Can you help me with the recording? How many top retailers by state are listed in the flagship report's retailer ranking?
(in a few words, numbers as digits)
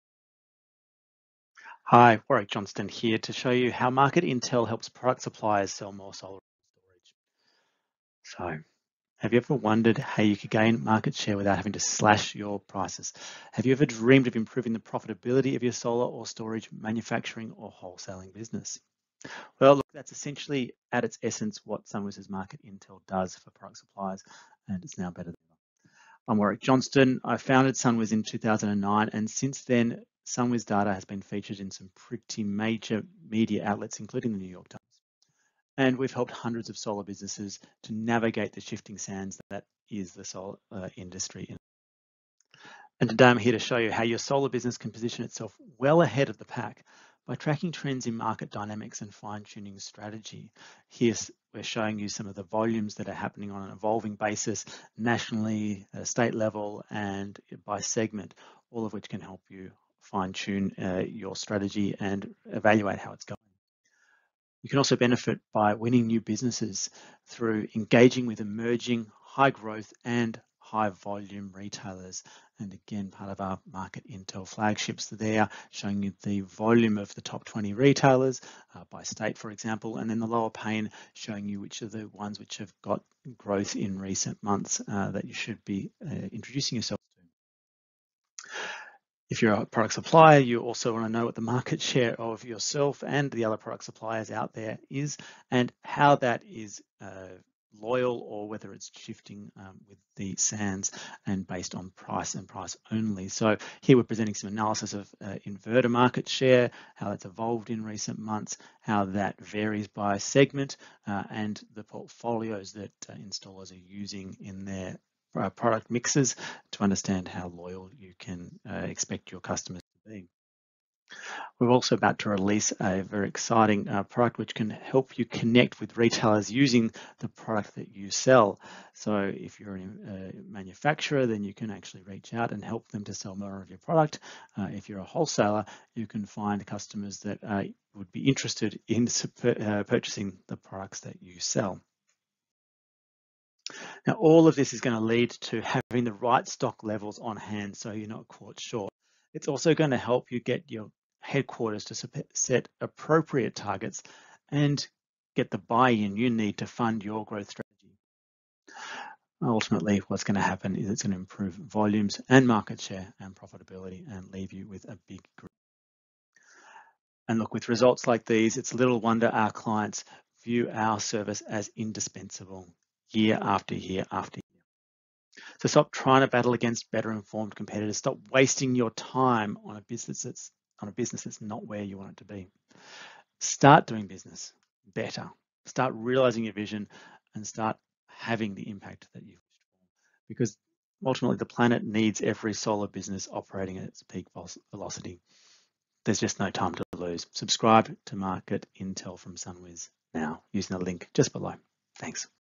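20.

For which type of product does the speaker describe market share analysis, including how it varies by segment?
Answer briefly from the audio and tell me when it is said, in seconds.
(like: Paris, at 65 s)
Inverter, at 105 s.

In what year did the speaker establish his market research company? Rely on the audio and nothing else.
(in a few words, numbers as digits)
2009.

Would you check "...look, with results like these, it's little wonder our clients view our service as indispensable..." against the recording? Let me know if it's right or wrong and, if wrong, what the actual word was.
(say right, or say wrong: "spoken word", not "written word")
right.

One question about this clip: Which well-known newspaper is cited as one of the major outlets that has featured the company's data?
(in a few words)
New York Times.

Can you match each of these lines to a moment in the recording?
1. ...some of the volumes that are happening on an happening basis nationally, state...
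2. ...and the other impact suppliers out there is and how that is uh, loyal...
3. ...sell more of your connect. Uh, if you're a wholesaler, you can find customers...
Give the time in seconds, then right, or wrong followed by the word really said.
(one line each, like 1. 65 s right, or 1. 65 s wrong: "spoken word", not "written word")
1. 52 s wrong: "evolving", not "happening"
2. 93 s wrong: "product", not "impact"
3. 133 s wrong: "product", not "connect".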